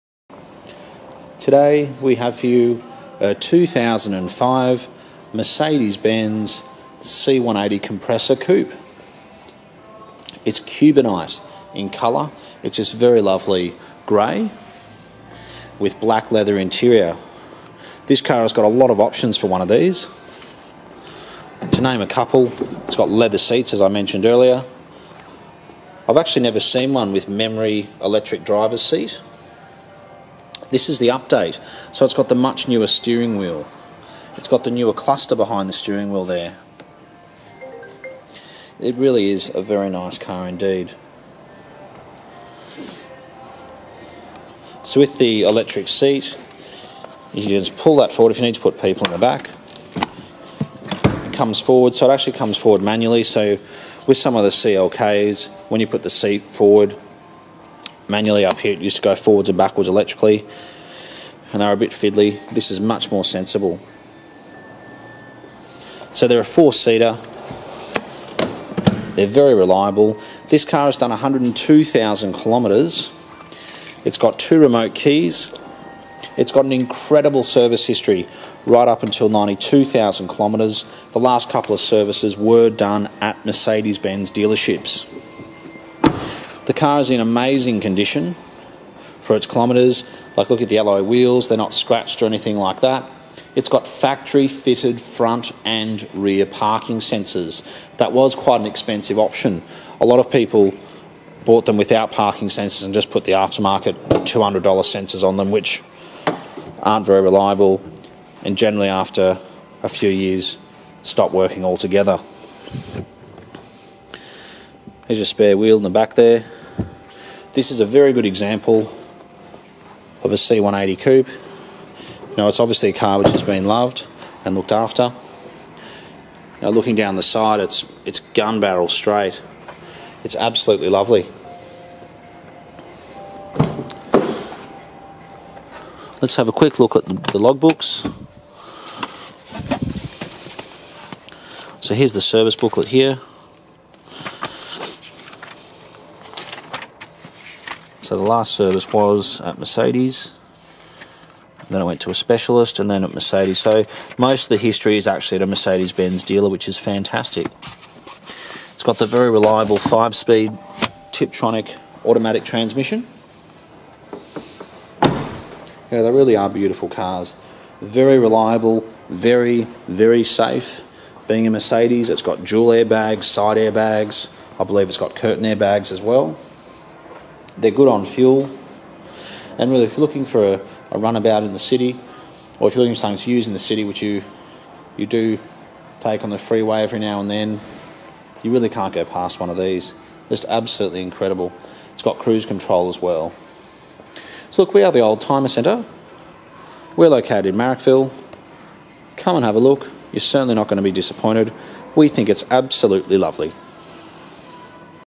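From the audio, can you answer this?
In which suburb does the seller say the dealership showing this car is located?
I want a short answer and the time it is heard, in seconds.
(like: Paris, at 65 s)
Marrickville, at 197 s.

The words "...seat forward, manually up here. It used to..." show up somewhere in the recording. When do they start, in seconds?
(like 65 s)
56 s.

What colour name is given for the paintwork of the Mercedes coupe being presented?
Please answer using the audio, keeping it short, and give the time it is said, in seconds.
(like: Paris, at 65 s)
Cubanite, at 10 s.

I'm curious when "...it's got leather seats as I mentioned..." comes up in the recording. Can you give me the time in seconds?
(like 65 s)
22 s.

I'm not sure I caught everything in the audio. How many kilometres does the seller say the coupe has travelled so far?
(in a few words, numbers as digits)
102,000 kilometres.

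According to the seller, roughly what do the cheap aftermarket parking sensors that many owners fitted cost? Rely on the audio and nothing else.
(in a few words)
$200.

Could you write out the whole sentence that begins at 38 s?
It really is a very nice car indeed.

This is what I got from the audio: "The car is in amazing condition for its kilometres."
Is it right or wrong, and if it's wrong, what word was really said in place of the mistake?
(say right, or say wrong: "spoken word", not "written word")
right.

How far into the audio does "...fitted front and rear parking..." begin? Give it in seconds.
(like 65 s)
94 s.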